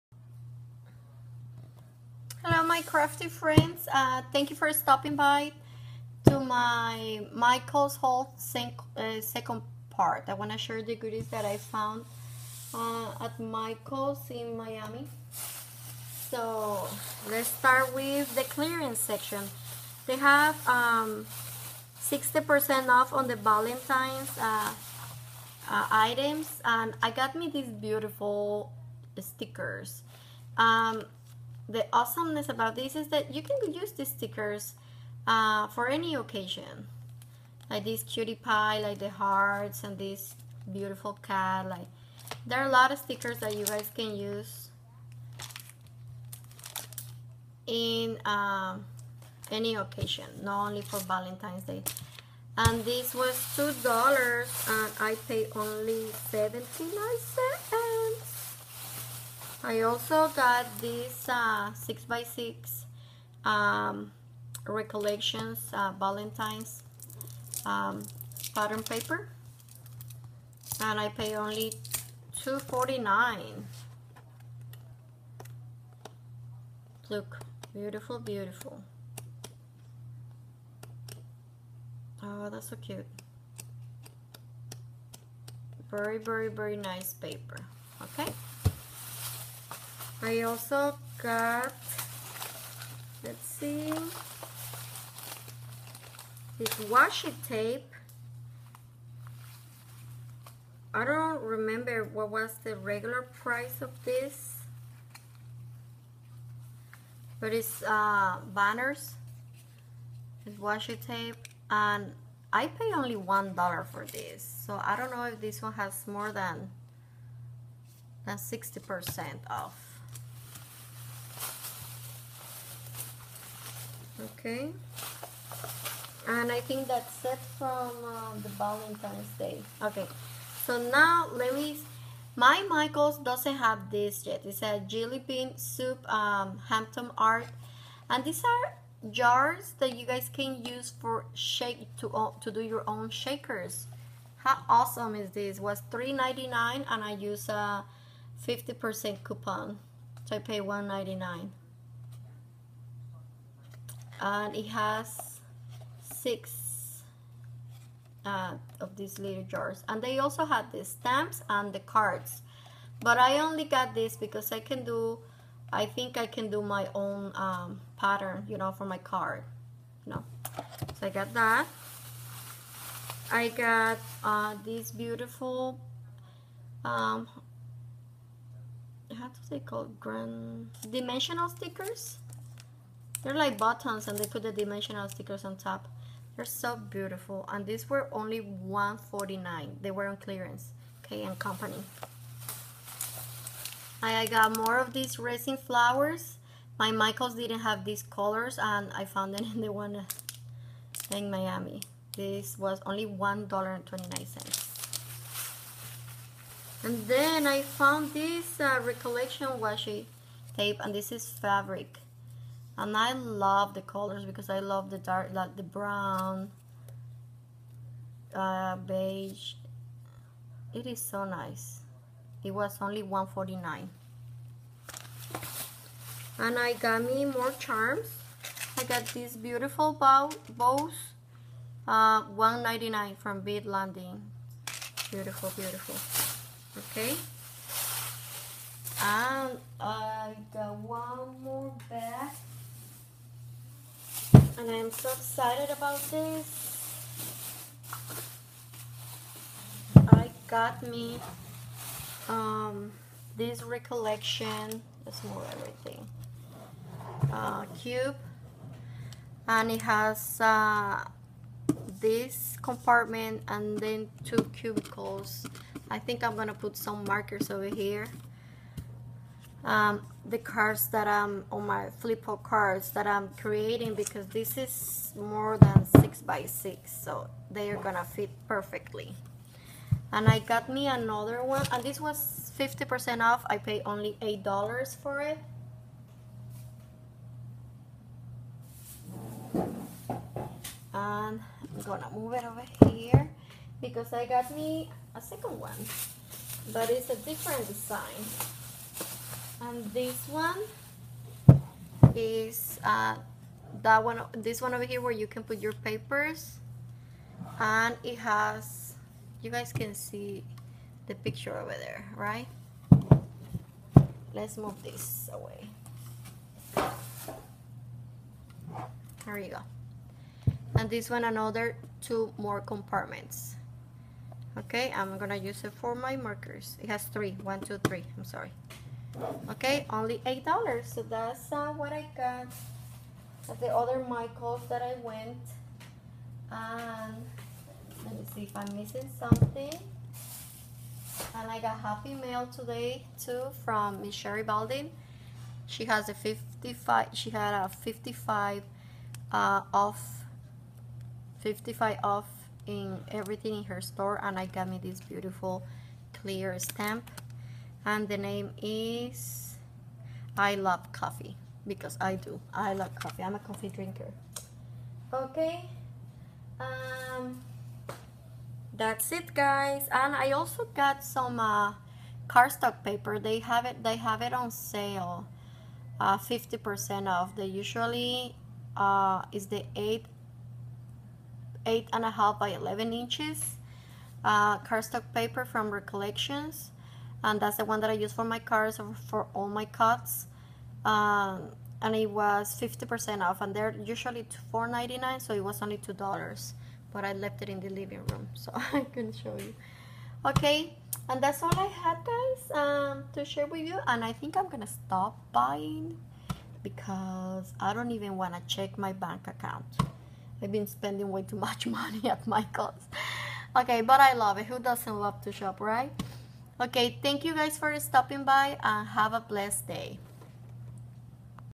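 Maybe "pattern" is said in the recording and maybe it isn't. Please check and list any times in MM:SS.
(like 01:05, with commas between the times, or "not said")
01:08, 02:47.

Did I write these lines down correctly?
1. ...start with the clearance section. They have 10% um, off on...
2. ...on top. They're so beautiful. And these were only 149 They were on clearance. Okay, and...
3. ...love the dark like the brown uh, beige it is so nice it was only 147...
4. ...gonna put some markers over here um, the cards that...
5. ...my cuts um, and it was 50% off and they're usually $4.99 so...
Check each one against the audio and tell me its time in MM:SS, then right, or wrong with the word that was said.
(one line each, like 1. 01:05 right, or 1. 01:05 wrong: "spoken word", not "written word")
1. 00:17 wrong: "60", not "10"
2. 03:05 right
3. 03:34 wrong: "149", not "147"
4. 04:26 right
5. 06:29 right.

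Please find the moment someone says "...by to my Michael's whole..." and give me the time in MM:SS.
00:05.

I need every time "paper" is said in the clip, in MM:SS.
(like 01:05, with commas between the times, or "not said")
01:08, 01:27, 05:05, 06:12, 06:25.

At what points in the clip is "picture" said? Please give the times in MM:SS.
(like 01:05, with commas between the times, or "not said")
05:11.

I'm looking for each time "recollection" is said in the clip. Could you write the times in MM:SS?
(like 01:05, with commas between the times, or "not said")
01:04, 03:28, 04:13, 06:25.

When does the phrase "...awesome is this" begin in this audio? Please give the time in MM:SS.
02:24.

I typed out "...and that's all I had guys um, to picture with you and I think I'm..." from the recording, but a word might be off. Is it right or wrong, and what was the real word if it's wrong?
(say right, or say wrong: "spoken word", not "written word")
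wrong: "share", not "picture".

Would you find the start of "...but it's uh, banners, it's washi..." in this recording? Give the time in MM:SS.
01:47.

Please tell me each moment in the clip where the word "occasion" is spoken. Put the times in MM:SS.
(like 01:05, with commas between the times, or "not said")
00:36, 00:49.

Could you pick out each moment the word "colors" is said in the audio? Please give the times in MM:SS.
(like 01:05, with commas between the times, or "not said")
03:18, 03:33.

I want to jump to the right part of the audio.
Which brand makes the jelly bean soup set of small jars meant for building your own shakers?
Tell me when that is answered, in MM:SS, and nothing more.
02:16.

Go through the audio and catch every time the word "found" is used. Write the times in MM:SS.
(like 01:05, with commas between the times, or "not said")
00:11, 03:19, 03:27.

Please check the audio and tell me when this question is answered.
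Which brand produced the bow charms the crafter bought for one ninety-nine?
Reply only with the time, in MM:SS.
03:53.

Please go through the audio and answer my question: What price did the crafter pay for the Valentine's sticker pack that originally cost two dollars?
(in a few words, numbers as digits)
79 cents.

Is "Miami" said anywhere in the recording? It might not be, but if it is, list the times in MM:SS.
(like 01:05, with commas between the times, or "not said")
00:14, 03:21.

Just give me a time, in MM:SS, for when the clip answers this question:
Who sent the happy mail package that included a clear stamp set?
05:44.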